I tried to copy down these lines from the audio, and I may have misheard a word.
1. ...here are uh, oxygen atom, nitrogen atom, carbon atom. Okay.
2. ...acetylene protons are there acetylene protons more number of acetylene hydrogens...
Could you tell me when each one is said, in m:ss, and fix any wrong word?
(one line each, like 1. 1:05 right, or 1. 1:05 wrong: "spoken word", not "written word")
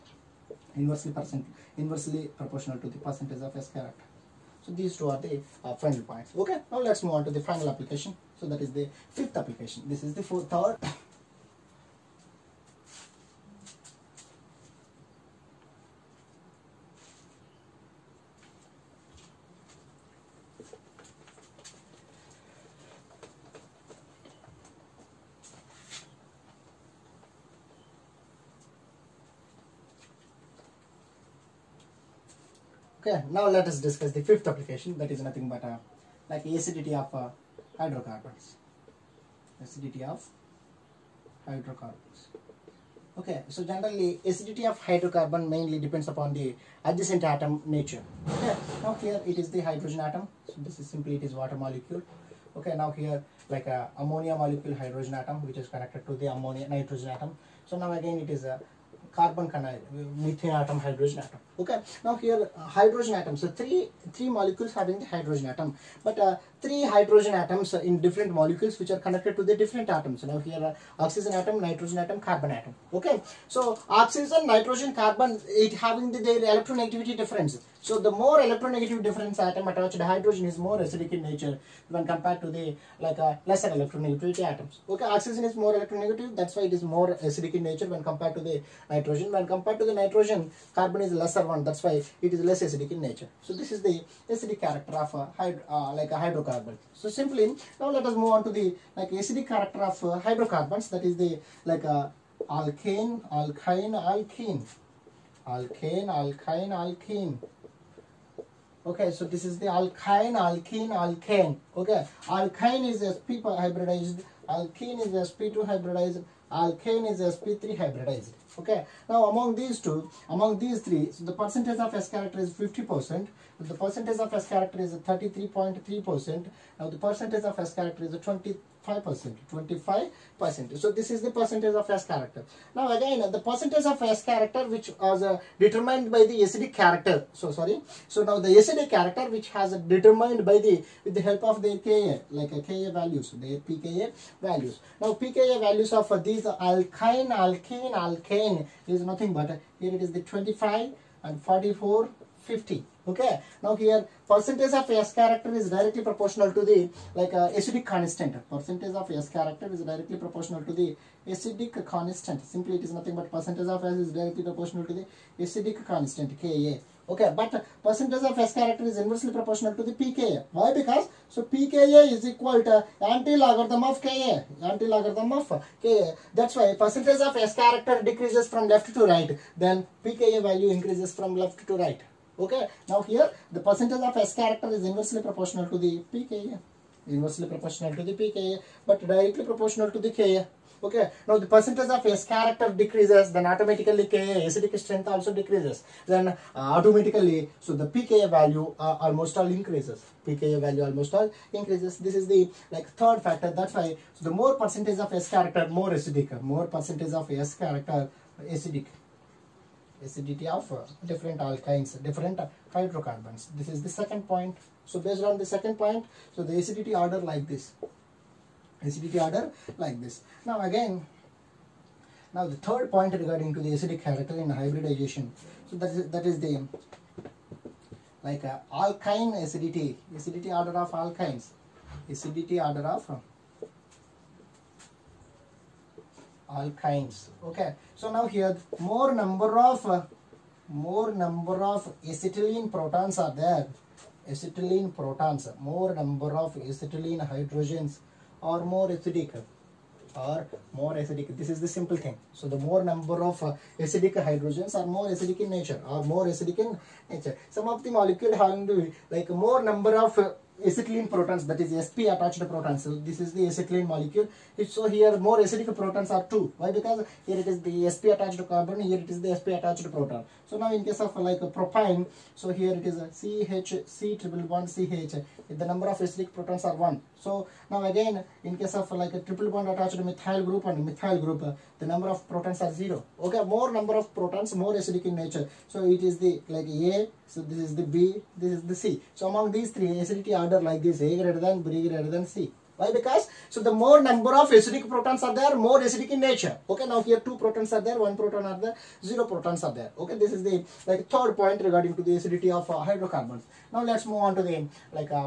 1. 1:10 right
2. 4:02 right.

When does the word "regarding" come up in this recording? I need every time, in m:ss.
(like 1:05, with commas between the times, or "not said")
3:43, 5:01.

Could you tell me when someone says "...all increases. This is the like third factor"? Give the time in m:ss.
3:21.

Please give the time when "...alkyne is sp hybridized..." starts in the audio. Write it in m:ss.
1:52.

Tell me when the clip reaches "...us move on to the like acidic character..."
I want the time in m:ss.
1:38.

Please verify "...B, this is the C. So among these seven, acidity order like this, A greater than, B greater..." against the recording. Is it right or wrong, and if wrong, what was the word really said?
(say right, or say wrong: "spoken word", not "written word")
wrong: "three", not "seven".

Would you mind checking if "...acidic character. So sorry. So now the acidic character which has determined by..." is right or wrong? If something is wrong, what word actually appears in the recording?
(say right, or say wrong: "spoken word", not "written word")
right.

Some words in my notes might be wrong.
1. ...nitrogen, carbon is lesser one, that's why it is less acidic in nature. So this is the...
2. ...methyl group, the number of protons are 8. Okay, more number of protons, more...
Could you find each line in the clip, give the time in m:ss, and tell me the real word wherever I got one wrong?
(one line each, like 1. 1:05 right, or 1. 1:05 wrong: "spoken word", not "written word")
1. 1:29 right
2. 4:40 wrong: "0", not "8".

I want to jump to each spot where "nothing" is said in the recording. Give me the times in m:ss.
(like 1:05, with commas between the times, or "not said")
0:35, 2:29, 2:42.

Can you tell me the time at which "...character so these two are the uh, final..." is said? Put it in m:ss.
0:03.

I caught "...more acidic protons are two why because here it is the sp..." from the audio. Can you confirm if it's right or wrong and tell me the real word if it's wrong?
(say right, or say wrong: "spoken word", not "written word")
right.